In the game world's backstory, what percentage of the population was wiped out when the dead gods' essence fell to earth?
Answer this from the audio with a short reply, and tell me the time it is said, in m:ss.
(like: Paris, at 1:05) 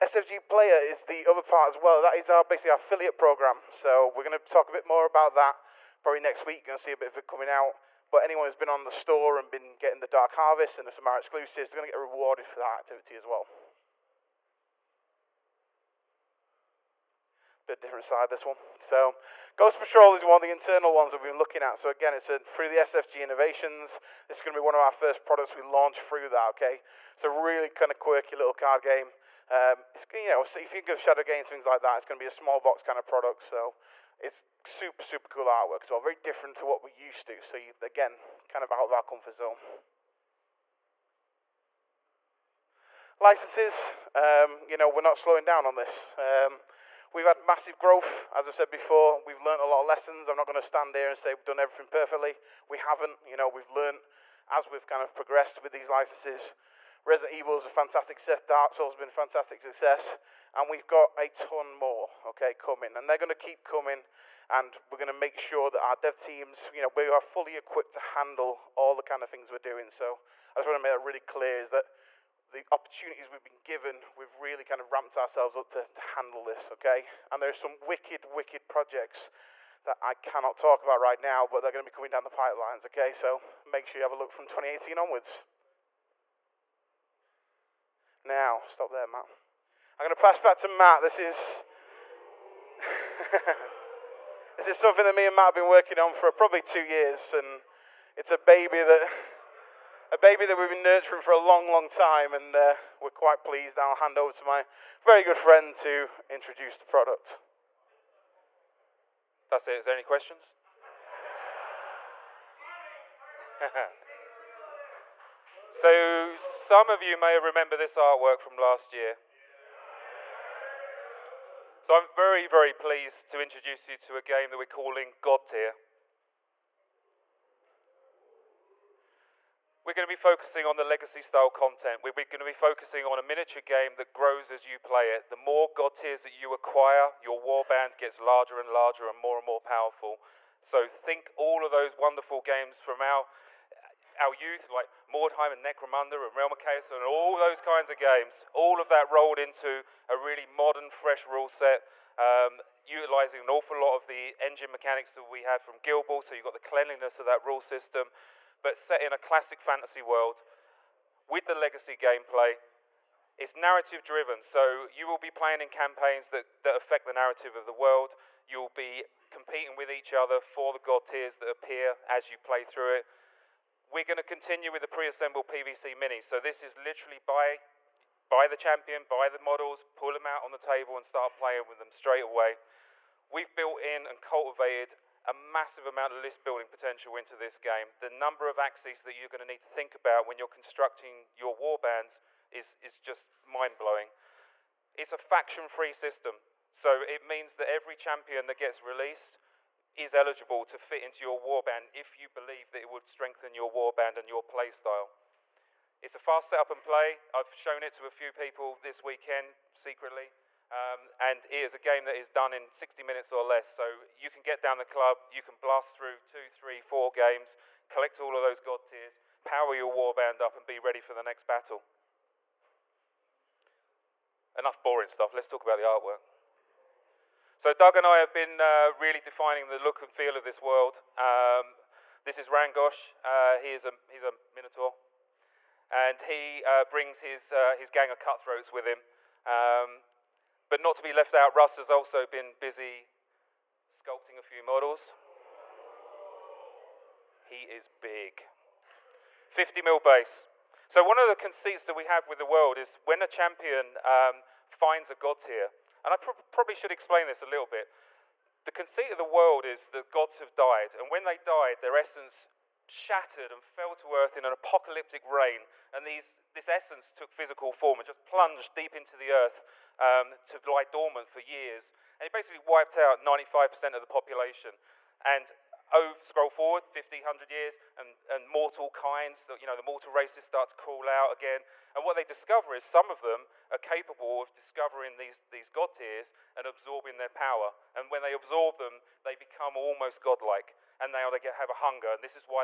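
95%, at 4:33.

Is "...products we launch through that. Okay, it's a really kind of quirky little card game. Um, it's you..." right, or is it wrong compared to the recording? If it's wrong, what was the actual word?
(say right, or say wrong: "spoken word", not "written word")
right.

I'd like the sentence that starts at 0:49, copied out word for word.
We've learned a lot of lessons.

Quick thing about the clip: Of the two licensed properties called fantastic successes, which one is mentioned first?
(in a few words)
Resident Evil.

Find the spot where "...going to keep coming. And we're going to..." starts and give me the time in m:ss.
1:03.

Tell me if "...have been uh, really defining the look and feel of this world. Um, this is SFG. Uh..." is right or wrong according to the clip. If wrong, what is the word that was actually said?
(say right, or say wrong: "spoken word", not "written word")
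wrong: "Rangosh", not "SFG".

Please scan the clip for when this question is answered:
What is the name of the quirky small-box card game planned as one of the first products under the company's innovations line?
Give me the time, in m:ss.
0:19.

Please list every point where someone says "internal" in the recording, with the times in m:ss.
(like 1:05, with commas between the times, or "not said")
0:20.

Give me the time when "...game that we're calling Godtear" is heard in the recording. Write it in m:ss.
2:04.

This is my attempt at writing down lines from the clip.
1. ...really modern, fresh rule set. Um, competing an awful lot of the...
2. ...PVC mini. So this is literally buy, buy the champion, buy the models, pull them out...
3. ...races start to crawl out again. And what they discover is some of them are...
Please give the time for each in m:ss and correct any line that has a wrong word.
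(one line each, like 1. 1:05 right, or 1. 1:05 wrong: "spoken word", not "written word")
1. 2:30 wrong: "utilizing", not "competing"
2. 2:55 right
3. 4:40 right.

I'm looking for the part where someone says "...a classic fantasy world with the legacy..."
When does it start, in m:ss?
2:39.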